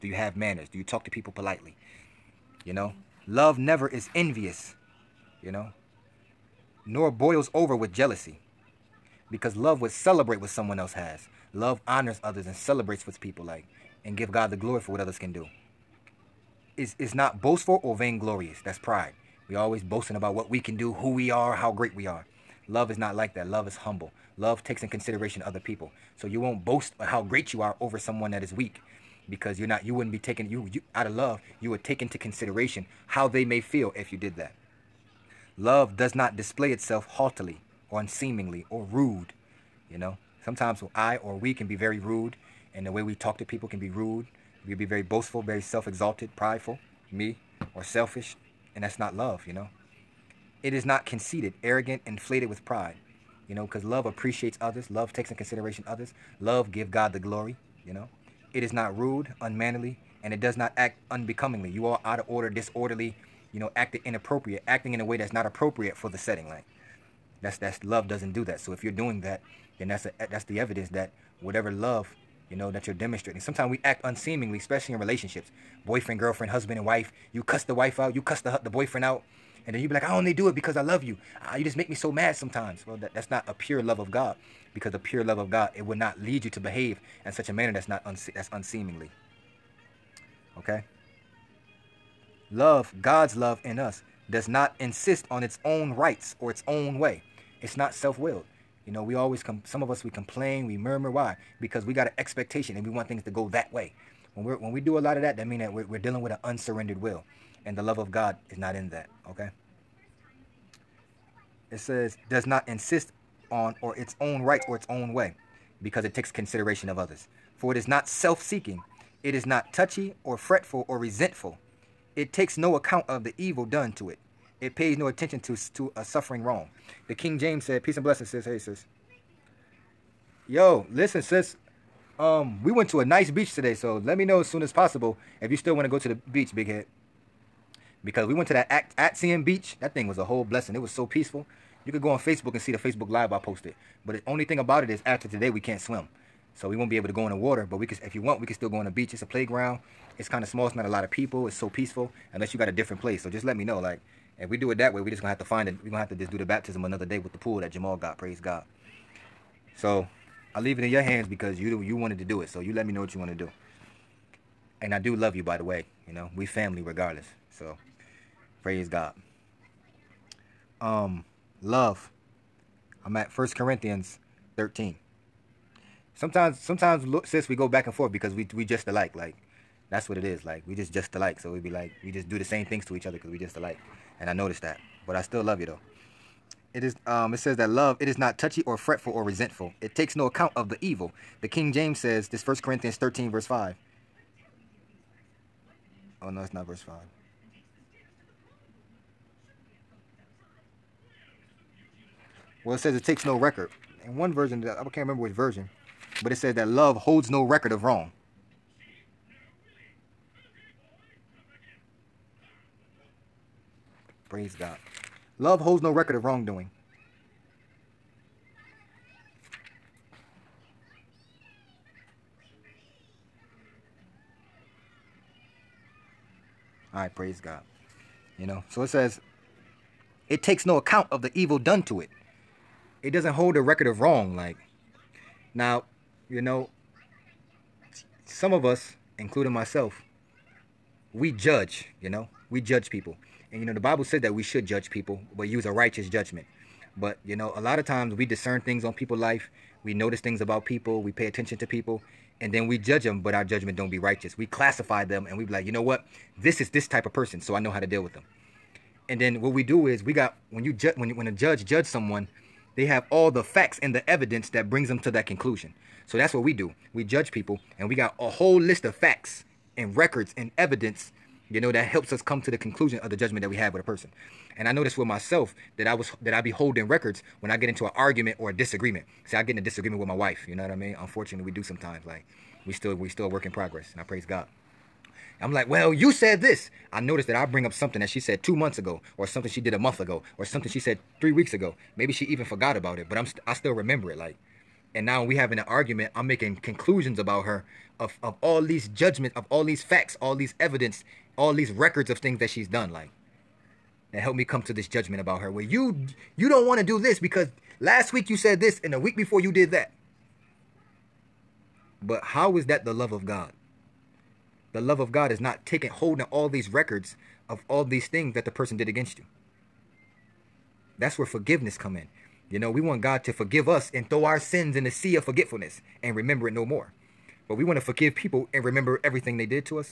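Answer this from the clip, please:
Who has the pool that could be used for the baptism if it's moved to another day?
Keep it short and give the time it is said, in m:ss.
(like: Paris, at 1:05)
Jamal, at 2:37.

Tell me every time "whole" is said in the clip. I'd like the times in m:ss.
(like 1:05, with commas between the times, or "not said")
2:20, 4:28.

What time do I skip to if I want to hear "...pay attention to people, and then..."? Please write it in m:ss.
4:11.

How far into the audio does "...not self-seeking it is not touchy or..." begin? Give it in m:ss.
1:57.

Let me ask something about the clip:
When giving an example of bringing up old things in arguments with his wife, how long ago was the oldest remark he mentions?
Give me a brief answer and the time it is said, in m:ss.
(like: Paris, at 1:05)
two months ago, at 4:48.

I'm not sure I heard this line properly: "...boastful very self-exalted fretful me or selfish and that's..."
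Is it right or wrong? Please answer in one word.
wrong.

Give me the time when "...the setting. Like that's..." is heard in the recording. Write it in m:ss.
1:06.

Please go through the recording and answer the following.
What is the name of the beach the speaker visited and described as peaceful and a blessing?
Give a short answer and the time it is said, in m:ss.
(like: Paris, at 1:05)
Atsian beach, at 2:18.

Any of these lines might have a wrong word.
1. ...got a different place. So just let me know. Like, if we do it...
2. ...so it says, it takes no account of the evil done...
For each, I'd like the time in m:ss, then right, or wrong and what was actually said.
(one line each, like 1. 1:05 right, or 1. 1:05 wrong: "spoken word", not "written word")
1. 2:32 right
2. 3:48 right.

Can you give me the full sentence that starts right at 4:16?
this is this type of person, so I know how to deal with them.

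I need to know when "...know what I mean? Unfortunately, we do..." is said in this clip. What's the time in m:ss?
4:40.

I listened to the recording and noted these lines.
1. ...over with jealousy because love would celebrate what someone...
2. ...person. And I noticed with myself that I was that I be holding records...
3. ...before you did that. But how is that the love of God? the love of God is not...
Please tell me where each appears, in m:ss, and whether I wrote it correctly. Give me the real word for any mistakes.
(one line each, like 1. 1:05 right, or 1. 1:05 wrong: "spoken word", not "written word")
1. 0:07 right
2. 4:33 right
3. 5:09 right.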